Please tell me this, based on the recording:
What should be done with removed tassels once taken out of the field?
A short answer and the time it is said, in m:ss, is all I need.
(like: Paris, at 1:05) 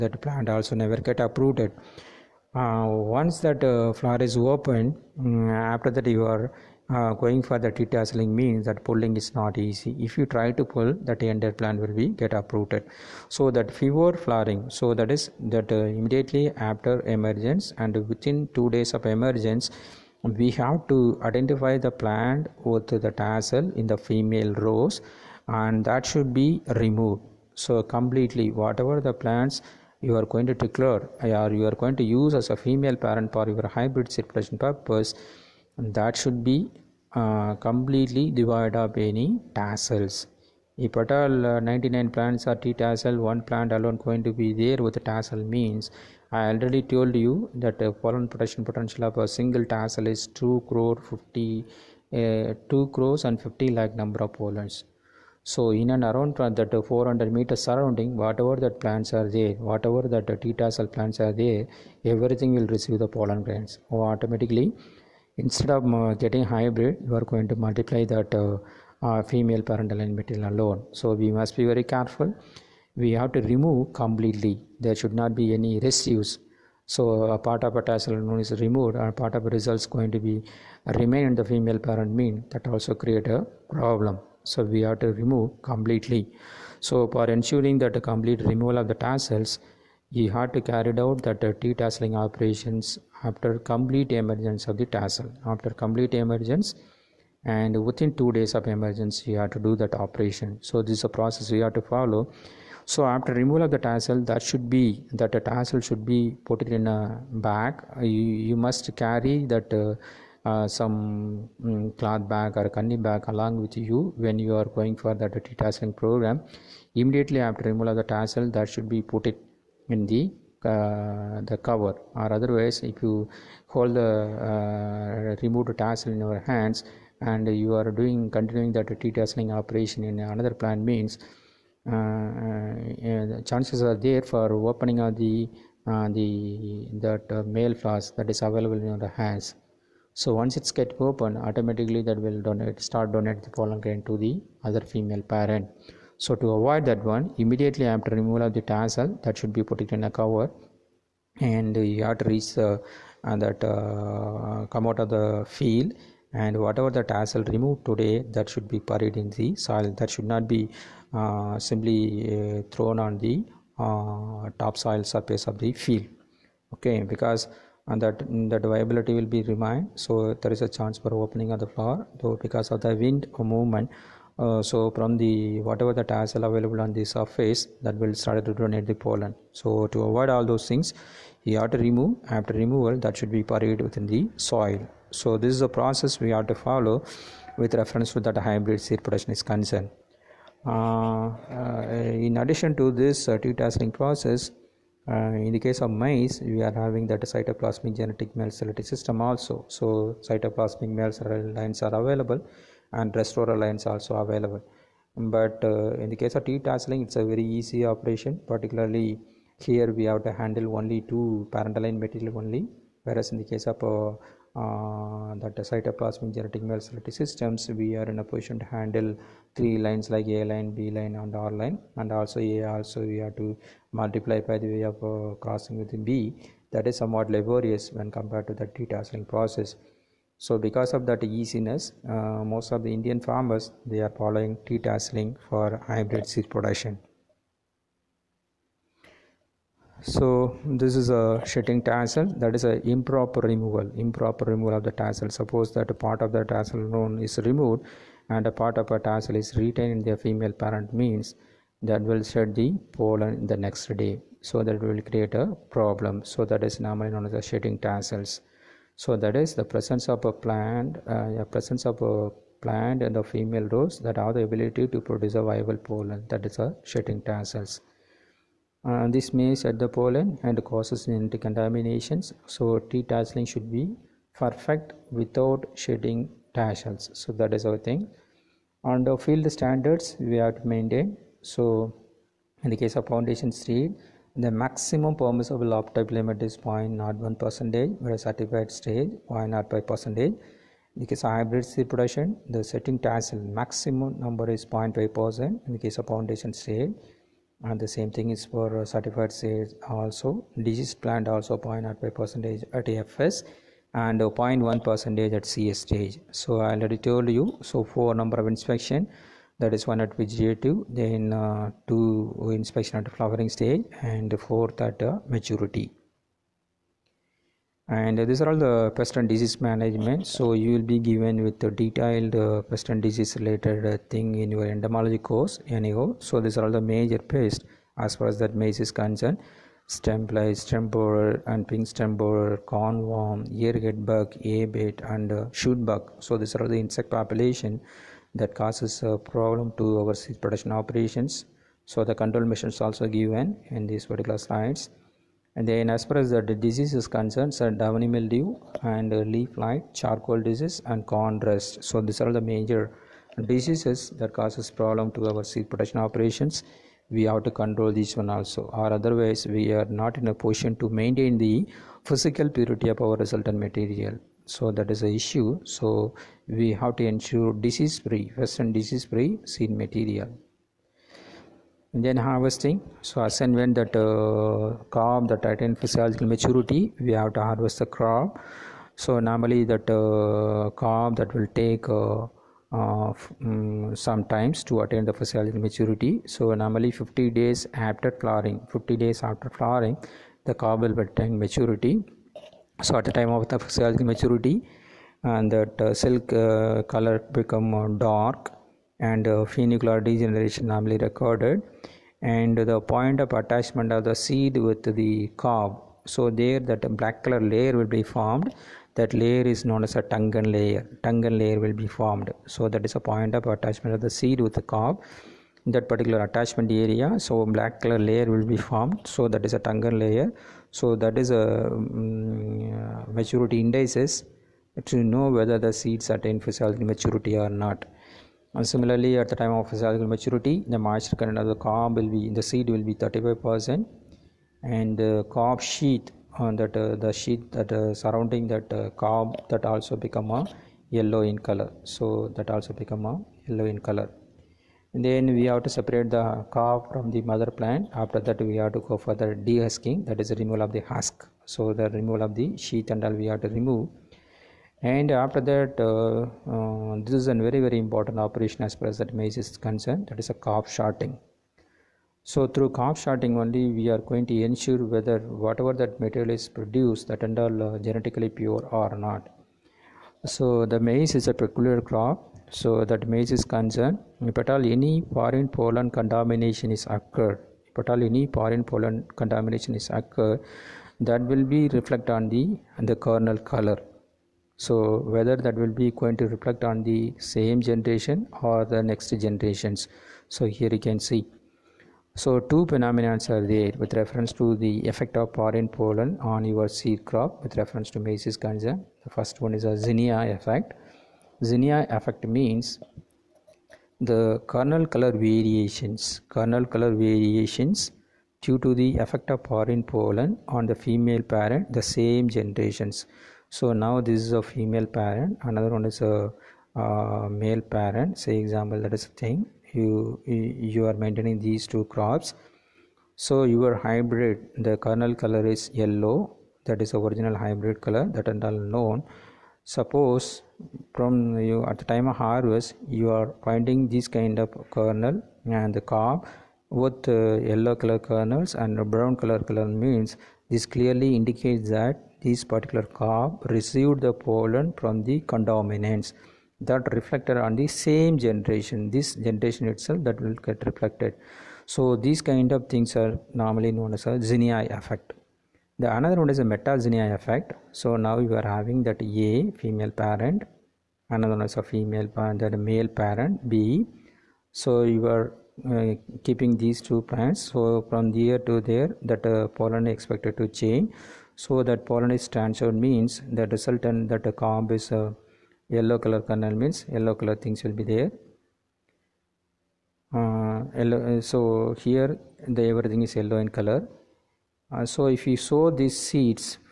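Buried in the soil, at 2:38.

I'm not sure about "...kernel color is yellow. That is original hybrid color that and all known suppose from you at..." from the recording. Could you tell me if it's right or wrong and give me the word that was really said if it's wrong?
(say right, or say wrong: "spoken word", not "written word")
right.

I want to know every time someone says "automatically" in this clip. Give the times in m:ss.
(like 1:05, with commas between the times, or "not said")
1:03, 2:21.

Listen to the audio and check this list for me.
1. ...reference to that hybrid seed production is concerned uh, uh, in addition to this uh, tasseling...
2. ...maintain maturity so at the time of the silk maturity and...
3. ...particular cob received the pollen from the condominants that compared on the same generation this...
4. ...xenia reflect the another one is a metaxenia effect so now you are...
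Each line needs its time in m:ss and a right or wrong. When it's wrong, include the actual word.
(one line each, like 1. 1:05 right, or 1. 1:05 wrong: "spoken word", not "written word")
1. 3:07 right
2. 6:31 wrong: "attain", not "maintain"
3. 9:02 wrong: "reflected", not "compared"
4. 9:14 wrong: "effect", not "reflect".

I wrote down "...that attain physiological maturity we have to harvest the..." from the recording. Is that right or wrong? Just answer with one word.
right.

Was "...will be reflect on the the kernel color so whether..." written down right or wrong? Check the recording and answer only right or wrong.
right.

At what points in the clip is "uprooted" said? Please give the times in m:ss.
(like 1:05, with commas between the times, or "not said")
0:01, 0:12.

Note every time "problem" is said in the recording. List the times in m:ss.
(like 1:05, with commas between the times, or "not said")
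1:23, 4:15, 5:39, 5:54.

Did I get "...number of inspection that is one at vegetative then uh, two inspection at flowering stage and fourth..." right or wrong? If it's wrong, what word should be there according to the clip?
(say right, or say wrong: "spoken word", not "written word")
right.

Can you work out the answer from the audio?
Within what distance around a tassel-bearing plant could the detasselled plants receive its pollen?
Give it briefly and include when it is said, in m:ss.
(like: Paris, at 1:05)
400 meters, at 0:56.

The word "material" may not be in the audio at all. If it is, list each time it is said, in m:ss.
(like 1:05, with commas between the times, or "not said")
1:10, 3:31, 6:03, 6:09, 7:46.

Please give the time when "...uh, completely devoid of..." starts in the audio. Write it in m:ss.
0:37.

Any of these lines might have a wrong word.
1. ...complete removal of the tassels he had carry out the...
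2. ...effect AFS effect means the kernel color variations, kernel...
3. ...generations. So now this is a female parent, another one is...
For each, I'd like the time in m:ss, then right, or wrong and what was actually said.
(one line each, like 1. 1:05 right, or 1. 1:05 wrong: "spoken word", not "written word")
1. 1:28 right
2. 8:20 wrong: "Xenia", not "AFS"
3. 8:32 right.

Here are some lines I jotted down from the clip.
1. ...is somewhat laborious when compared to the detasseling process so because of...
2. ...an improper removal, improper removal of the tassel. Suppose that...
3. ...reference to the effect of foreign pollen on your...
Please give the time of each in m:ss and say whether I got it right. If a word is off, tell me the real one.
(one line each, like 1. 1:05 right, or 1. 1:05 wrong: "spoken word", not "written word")
1. 3:46 right
2. 4:02 right
3. 8:13 right.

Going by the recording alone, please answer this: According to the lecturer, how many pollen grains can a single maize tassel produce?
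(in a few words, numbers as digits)
2 crore 50 lakh.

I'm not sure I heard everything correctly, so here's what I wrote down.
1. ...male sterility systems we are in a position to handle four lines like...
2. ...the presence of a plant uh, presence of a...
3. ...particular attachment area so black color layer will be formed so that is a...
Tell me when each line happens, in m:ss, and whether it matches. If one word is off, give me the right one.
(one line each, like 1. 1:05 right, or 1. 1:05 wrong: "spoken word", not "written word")
1. 3:36 wrong: "three", not "four"
2. 4:19 right
3. 6:55 right.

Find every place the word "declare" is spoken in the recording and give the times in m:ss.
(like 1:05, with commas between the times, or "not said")
0:30.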